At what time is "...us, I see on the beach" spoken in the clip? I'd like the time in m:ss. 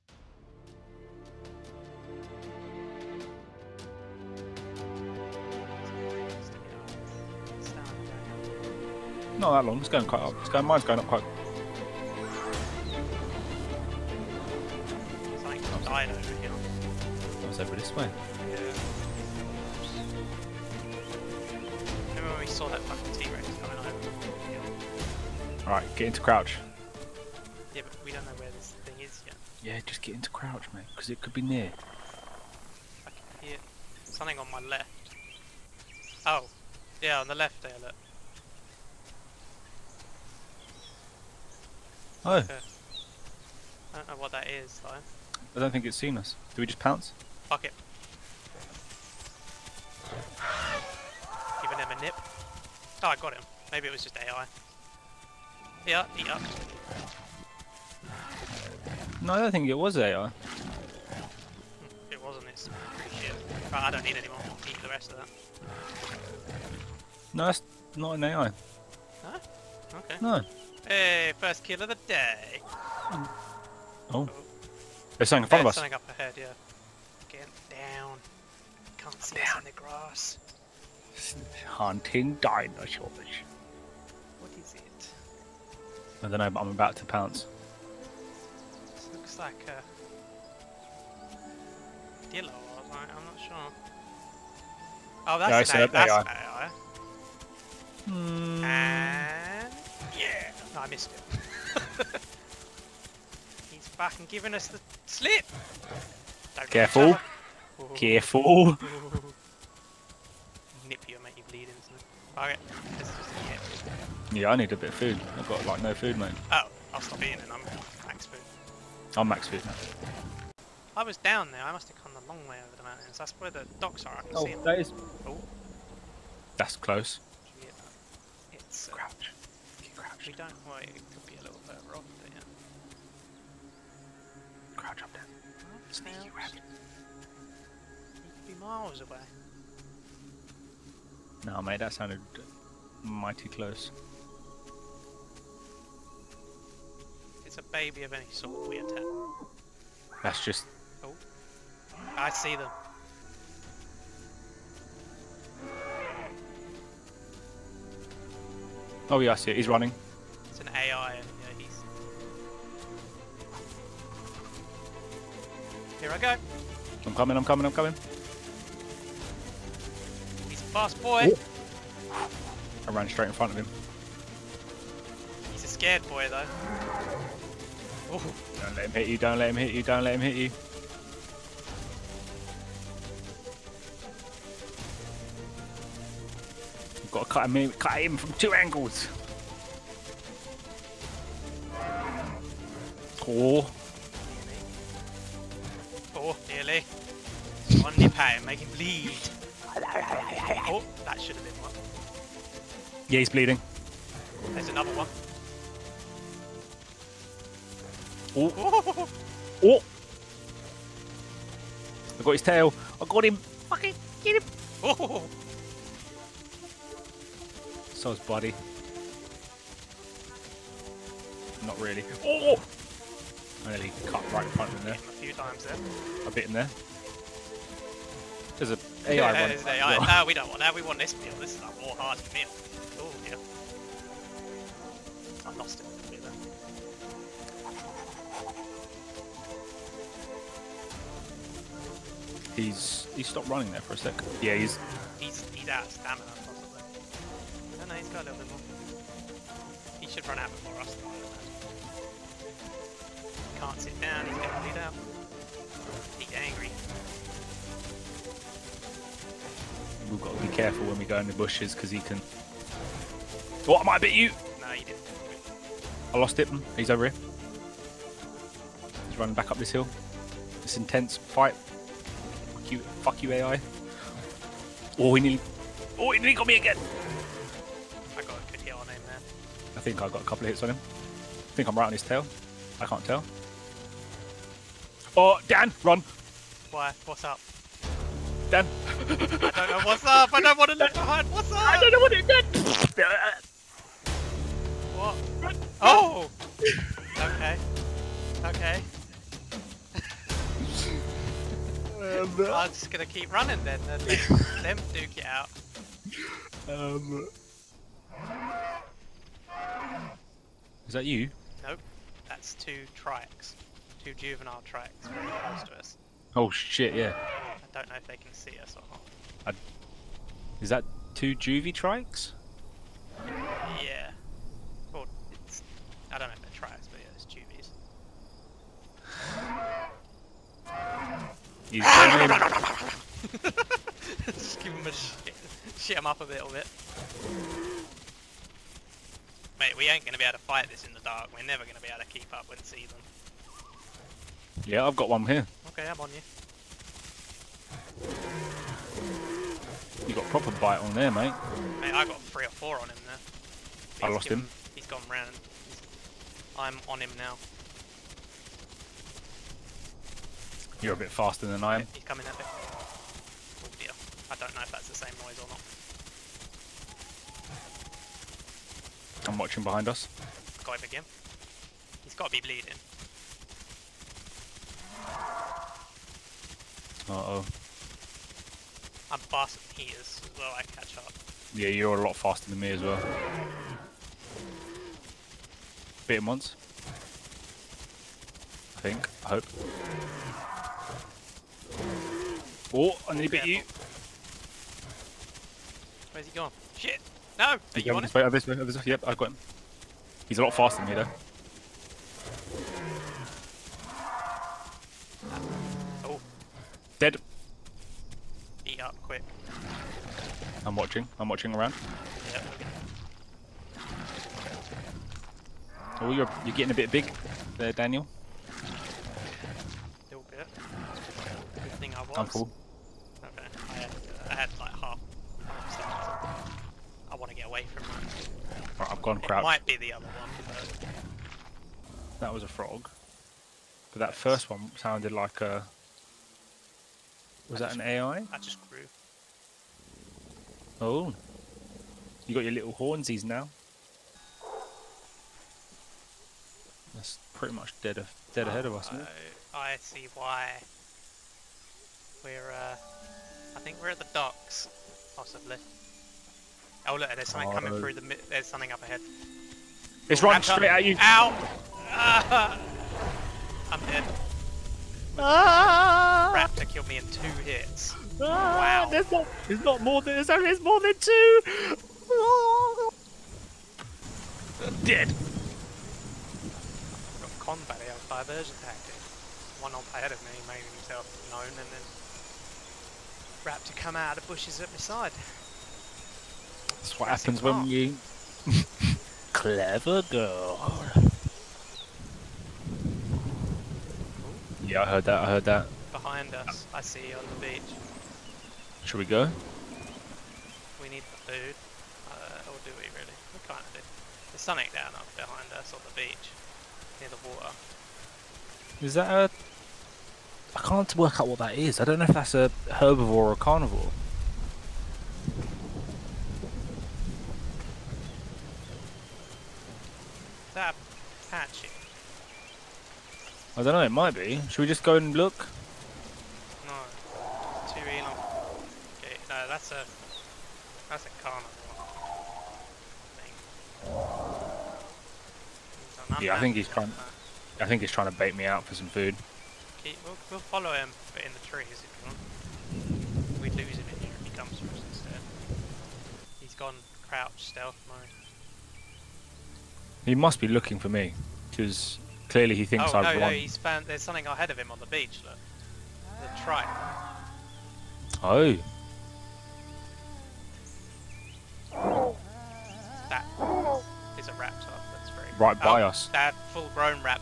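8:16.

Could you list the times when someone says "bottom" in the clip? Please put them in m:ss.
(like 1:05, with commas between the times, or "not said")
not said.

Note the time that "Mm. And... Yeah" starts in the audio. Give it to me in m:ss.
1:38.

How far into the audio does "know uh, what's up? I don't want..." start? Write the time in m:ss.
4:48.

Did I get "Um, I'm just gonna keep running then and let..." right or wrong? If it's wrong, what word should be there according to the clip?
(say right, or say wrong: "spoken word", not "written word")
right.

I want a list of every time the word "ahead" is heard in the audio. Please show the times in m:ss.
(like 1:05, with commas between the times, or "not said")
1:16, 7:28, 7:38, 7:59, 9:14.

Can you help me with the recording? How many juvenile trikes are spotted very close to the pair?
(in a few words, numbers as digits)
2.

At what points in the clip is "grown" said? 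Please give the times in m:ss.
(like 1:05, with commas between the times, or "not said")
9:26.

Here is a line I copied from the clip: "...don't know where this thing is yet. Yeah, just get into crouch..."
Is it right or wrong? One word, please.
right.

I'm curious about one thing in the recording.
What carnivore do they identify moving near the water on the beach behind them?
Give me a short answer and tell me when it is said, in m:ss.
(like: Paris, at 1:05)
Carno, at 8:50.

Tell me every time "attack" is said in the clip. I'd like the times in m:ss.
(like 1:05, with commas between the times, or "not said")
2:28.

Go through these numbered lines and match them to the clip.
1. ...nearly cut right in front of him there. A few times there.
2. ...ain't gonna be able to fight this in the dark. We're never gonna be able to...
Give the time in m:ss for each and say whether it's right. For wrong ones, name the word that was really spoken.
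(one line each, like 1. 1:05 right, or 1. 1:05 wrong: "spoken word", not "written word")
1. 3:43 right
2. 5:39 right.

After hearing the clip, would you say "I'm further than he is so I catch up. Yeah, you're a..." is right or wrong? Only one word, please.
wrong.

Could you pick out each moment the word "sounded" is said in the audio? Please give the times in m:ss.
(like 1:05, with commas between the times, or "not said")
2:21, 7:14.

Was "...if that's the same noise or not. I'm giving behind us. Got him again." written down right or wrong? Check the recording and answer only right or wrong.
wrong.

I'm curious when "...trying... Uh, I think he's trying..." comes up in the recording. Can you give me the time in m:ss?
8:56.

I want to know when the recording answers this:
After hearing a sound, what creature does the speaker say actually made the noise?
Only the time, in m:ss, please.
7:12.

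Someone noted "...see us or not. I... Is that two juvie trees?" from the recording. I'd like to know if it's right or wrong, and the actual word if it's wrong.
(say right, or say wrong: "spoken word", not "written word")
wrong: "trikes", not "trees".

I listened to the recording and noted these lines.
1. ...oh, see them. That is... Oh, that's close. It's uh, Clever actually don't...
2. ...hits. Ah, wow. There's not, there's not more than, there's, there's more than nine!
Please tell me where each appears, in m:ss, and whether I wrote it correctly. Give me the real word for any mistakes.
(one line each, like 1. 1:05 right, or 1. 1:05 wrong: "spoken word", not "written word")
1. 2:04 wrong: "Crouch", not "Clever"
2. 7:47 wrong: "two", not "nine".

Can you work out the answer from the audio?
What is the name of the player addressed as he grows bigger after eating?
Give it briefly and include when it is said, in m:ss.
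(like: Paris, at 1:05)
Daniel, at 6:57.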